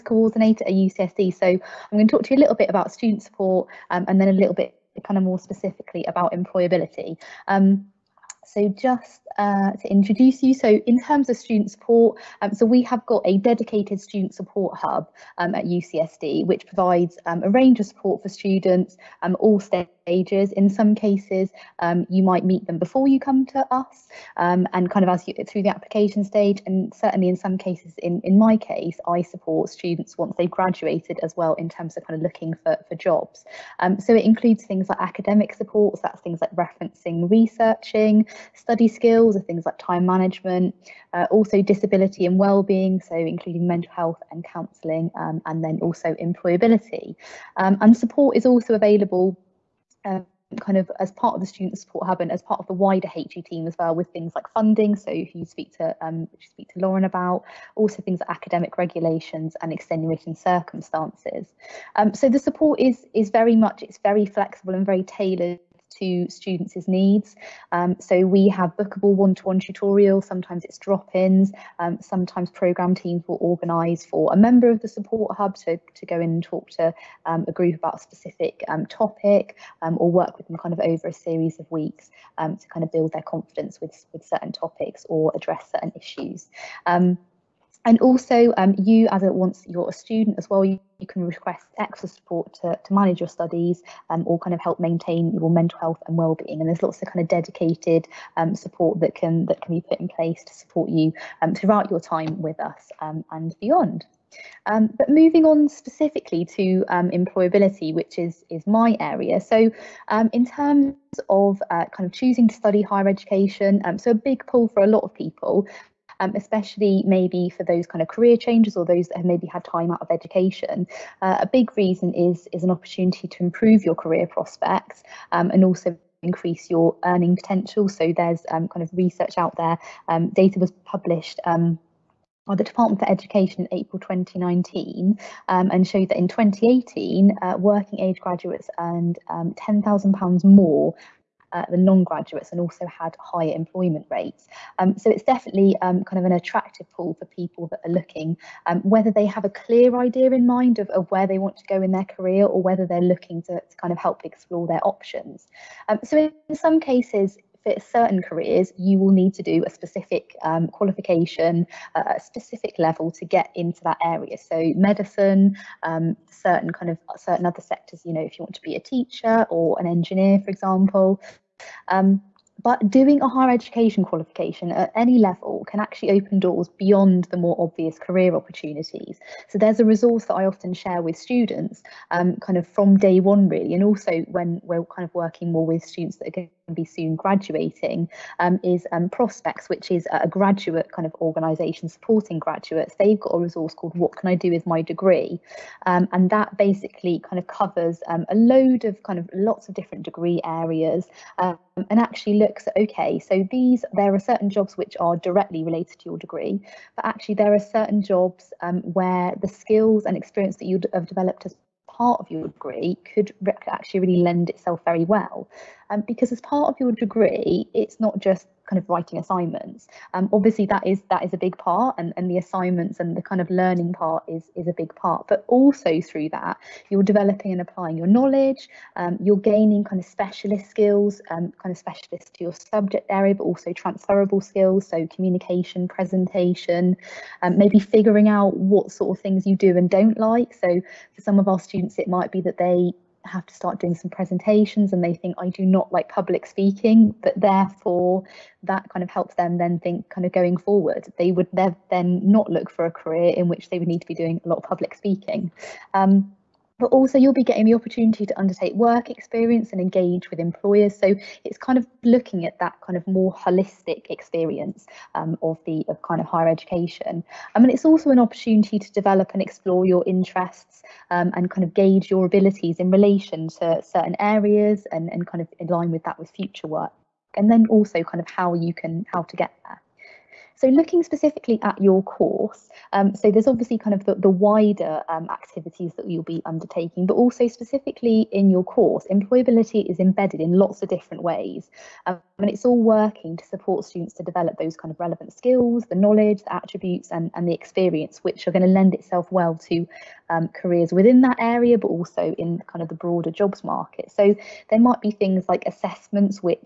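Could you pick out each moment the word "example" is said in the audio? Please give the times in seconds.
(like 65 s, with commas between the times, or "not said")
170 s.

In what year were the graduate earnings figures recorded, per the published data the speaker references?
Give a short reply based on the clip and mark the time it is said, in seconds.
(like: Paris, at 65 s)
2018, at 136 s.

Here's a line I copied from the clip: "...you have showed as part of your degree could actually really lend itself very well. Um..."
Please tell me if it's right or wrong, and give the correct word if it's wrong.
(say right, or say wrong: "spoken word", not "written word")
wrong: "developed", not "showed".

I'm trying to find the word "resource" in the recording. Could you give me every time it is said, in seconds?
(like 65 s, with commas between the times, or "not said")
179 s, 193 s.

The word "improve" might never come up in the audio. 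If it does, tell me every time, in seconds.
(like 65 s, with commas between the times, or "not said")
123 s.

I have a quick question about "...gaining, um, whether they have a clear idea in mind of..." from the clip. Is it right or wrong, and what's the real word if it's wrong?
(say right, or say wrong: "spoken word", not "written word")
wrong: "looking", not "gaining".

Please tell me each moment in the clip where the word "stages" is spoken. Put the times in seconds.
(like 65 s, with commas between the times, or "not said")
19 s, 26 s.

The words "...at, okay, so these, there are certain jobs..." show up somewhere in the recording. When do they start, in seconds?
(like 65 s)
202 s.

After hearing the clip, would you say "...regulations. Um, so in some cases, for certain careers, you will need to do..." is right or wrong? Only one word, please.
wrong.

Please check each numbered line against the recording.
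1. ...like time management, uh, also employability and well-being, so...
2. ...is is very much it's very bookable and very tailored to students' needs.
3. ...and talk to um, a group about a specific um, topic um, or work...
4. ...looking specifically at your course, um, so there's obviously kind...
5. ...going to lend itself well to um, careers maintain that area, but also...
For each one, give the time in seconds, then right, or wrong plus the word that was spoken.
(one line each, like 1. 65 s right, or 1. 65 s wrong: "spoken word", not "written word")
1. 39 s wrong: "disability", not "employability"
2. 62 s wrong: "flexible", not "bookable"
3. 76 s right
4. 280 s right
5. 298 s wrong: "within", not "maintain".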